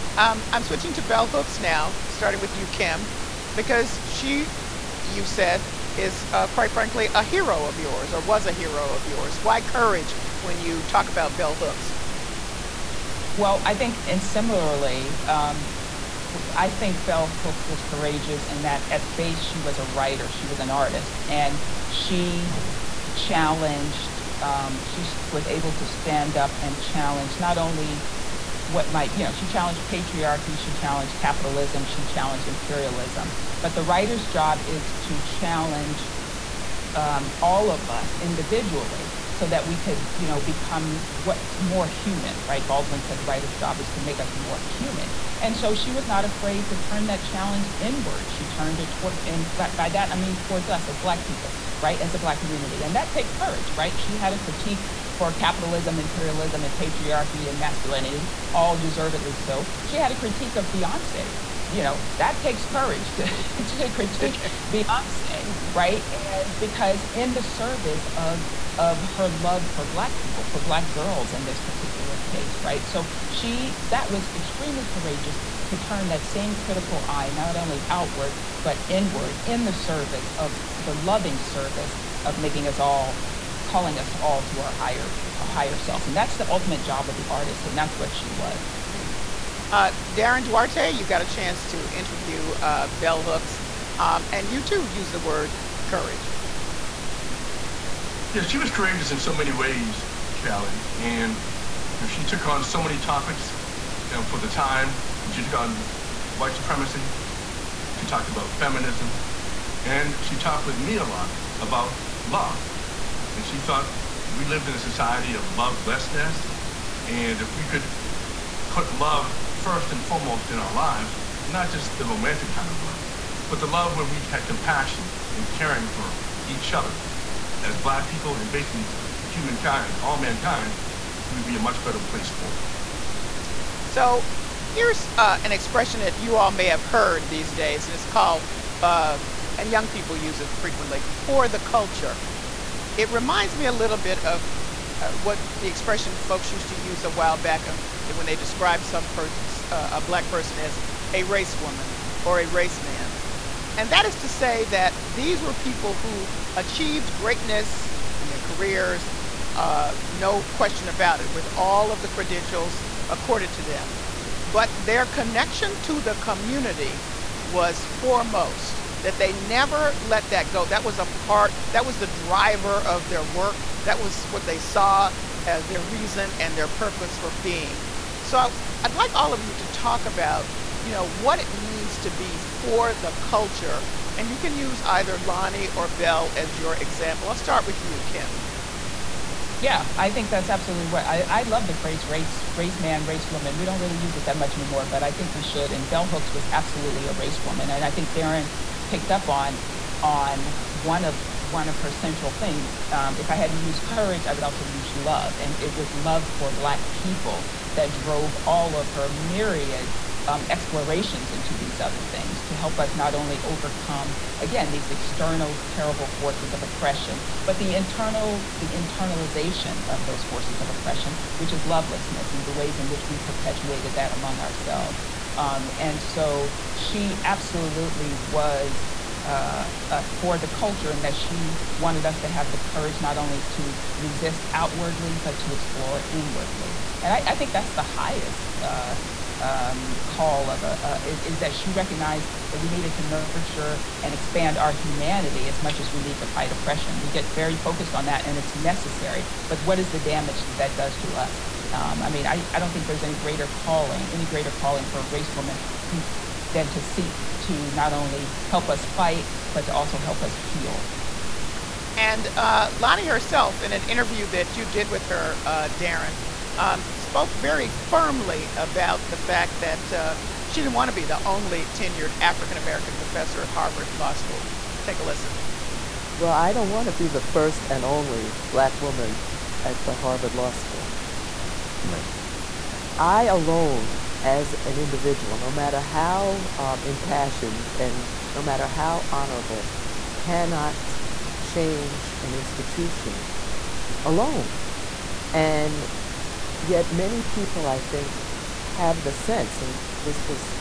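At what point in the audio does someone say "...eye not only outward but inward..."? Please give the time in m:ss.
1:17.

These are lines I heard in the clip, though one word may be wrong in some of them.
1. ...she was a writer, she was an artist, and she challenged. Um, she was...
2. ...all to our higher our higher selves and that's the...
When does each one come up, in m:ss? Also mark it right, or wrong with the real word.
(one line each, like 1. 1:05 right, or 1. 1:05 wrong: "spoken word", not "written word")
1. 0:19 right
2. 1:24 right.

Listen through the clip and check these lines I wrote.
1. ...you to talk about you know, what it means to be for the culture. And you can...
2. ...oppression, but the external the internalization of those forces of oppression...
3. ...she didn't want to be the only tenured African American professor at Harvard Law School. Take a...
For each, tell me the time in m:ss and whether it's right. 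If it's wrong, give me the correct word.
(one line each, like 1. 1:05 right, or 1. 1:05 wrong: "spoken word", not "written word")
1. 2:59 right
2. 3:36 wrong: "internal", not "external"
3. 4:30 right.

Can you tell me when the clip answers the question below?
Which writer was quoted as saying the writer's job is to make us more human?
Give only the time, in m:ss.
0:42.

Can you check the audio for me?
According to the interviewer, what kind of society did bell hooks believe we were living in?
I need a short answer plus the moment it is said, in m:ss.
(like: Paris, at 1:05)
A society of lovelessness, at 1:54.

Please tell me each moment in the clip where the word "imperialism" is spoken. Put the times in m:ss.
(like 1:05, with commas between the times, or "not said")
0:32, 0:55.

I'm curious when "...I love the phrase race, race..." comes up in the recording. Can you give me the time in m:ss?
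3:11.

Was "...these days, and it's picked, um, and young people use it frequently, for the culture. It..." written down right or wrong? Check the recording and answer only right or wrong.
wrong.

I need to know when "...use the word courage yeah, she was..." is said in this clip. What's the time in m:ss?
1:34.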